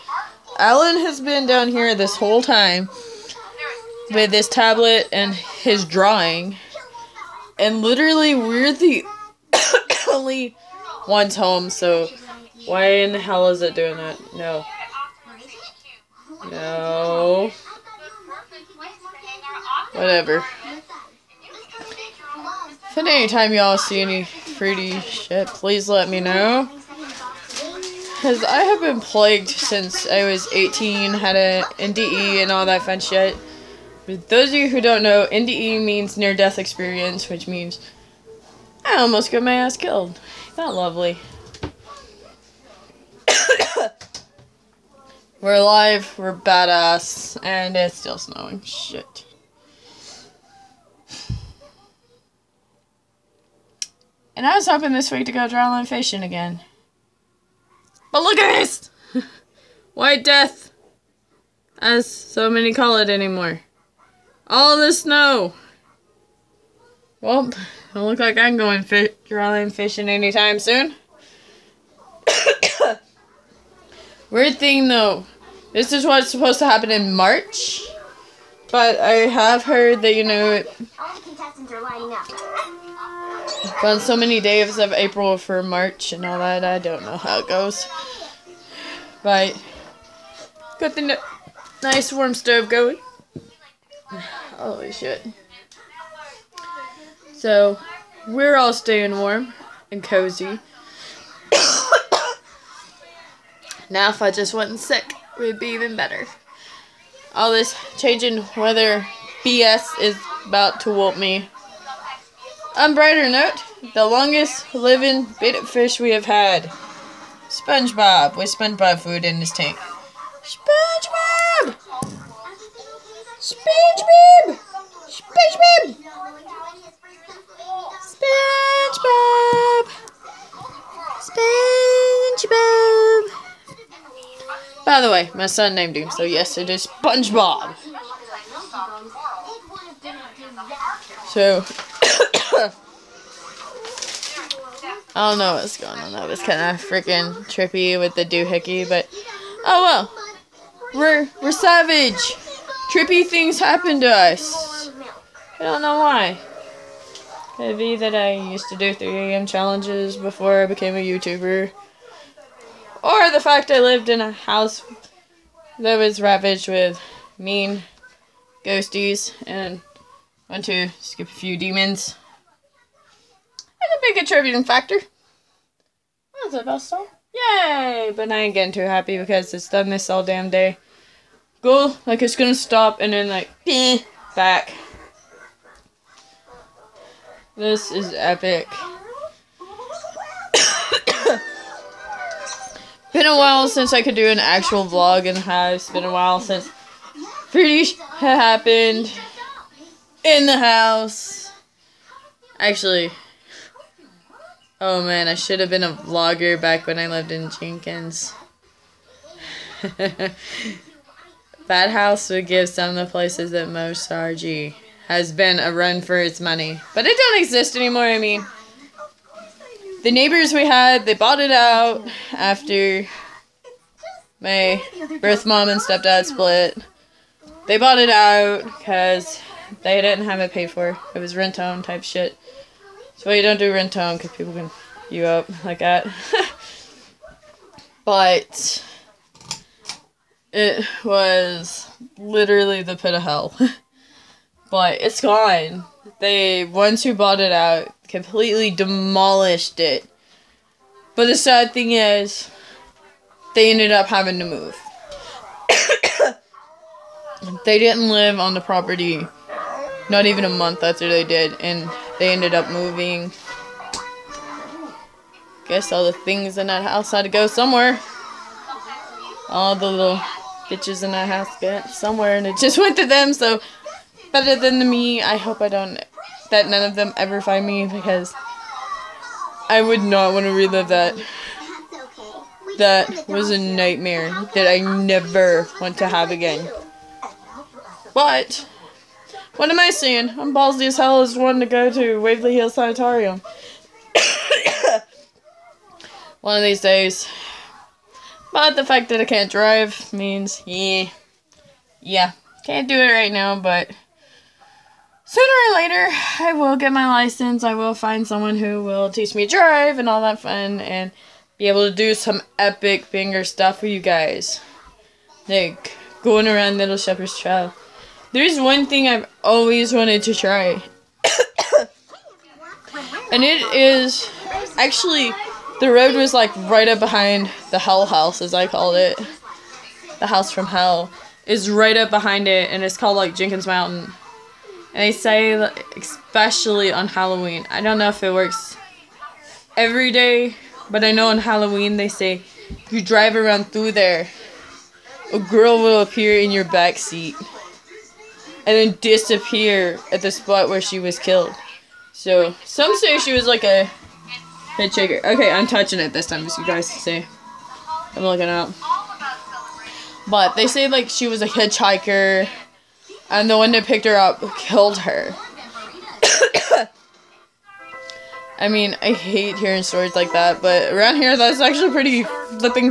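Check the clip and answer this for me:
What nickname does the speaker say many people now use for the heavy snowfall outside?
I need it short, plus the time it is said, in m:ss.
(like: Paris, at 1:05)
White Death, at 0:59.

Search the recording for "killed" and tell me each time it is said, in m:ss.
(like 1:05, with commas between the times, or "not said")
0:39, 5:51, 6:04.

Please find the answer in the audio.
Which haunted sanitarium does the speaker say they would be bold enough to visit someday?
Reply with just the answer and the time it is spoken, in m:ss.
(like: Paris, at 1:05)
Waverly Hills Sanitarium, at 4:52.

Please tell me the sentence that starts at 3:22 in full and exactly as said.
Actually, oh man, I should have been a vlogger back when I lived in Jenkins.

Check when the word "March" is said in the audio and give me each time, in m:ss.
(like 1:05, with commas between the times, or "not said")
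1:17, 1:25.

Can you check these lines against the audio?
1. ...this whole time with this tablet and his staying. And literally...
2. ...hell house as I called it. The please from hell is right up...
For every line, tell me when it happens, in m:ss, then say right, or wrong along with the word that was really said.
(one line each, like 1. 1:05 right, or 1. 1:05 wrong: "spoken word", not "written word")
1. 0:01 wrong: "drawing", not "staying"
2. 5:27 wrong: "house", not "please".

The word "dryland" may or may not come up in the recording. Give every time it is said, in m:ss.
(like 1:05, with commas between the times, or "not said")
0:55, 1:09.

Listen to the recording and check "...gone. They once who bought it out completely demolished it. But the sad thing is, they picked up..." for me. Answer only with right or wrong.
wrong.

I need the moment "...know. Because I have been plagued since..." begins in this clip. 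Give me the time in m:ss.
0:26.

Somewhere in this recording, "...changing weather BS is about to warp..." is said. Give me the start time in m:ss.
1:47.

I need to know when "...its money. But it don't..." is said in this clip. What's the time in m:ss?
3:36.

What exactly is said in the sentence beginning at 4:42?
That was a nightmare that I never want to have again.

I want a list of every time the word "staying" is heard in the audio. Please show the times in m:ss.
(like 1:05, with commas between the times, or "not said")
1:38.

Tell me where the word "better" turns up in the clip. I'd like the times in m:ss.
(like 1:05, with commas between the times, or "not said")
1:45, 4:34.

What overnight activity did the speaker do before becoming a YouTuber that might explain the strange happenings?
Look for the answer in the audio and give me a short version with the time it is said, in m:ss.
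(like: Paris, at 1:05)
3 a.m. challenges, at 2:38.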